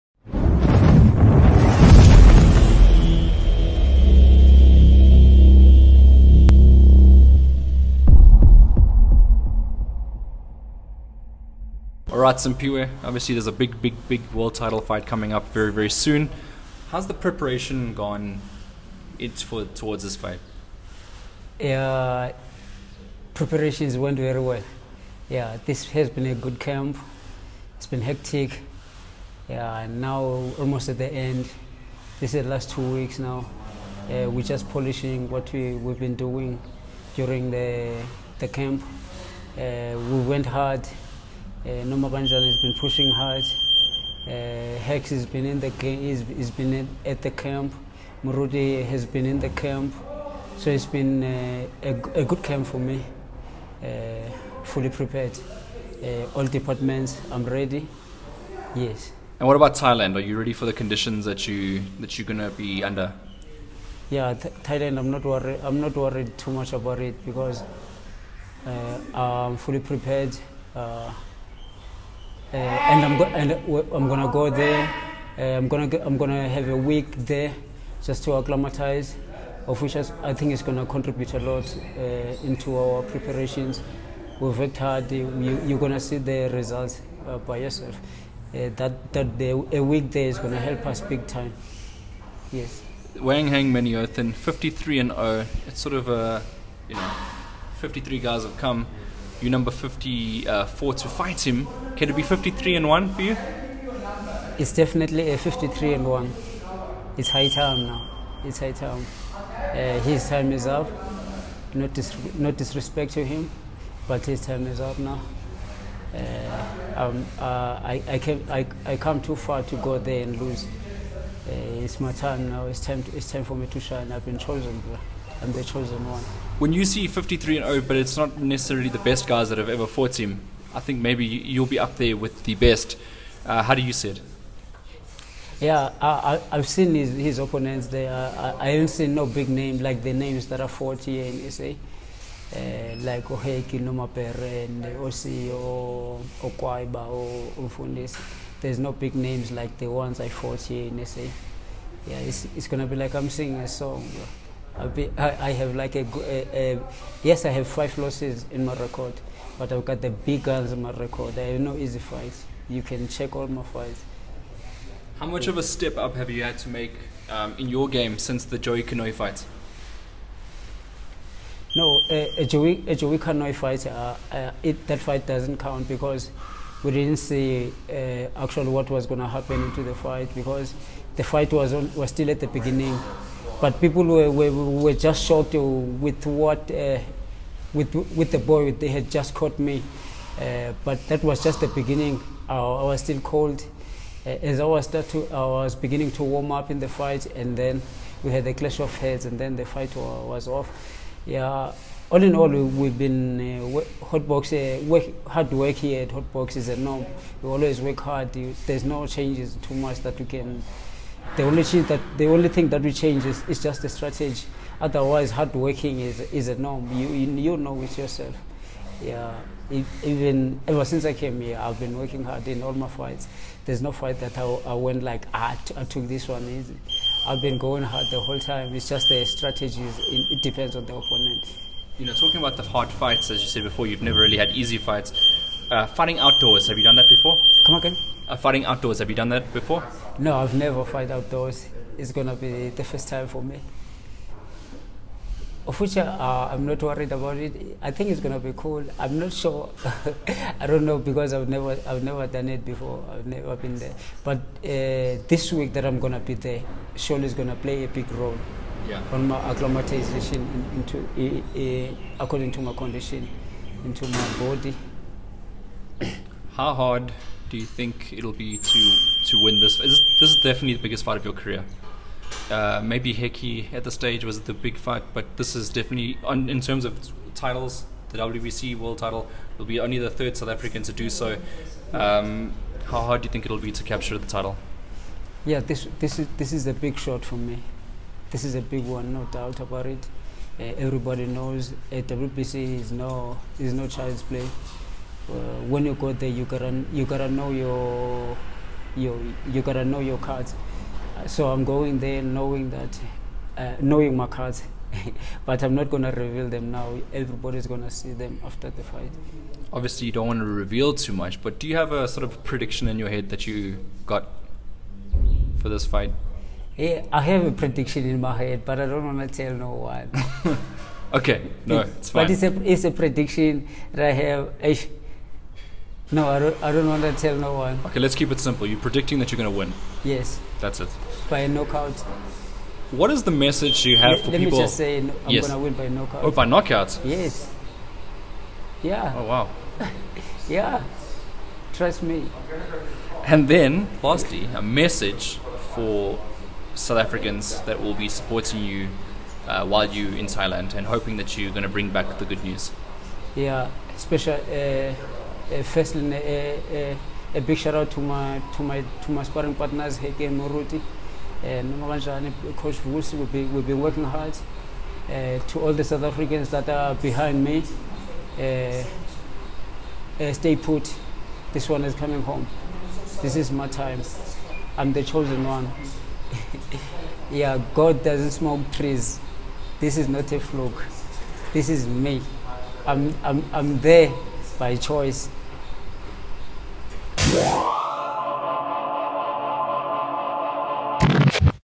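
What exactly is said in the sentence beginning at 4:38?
The WBC world title will be only the third South African to do so.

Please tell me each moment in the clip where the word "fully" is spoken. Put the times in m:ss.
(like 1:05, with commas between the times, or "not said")
0:54, 1:09.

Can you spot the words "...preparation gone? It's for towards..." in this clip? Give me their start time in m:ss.
0:17.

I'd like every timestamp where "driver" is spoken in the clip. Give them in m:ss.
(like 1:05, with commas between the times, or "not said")
not said.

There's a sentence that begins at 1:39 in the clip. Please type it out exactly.
You're number 54 uh, to fight him.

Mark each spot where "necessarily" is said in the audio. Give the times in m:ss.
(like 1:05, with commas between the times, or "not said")
2:08.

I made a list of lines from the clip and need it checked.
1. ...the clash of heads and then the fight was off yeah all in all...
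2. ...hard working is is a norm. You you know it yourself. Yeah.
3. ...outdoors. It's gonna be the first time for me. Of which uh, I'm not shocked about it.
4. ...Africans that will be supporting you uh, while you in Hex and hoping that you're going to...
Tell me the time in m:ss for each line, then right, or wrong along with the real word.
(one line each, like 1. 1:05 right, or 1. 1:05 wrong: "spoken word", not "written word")
1. 3:18 right
2. 3:35 right
3. 4:01 wrong: "worried", not "shocked"
4. 5:46 wrong: "Thailand", not "Hex".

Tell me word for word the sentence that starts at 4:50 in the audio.
Uh, everybody knows uh, WBC is no is no child's play.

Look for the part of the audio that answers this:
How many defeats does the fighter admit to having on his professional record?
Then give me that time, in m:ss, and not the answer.
2:37.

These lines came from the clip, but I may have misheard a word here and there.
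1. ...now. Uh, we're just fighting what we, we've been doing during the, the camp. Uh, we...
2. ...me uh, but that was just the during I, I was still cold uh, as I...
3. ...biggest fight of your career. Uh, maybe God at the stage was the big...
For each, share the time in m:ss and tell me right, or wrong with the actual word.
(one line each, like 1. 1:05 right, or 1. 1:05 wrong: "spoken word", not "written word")
1. 0:33 wrong: "polishing", not "fighting"
2. 3:09 wrong: "beginning", not "during"
3. 4:30 wrong: "Hekkie", not "God".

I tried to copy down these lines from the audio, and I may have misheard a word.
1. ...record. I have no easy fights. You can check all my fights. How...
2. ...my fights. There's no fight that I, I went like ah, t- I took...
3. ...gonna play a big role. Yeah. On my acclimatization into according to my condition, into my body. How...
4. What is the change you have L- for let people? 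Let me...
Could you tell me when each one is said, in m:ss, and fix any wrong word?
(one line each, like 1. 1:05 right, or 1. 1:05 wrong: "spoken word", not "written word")
1. 2:40 right
2. 3:42 right
3. 4:17 right
4. 5:32 wrong: "message", not "change".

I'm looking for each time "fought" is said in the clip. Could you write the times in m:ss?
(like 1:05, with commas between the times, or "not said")
2:09, 2:30.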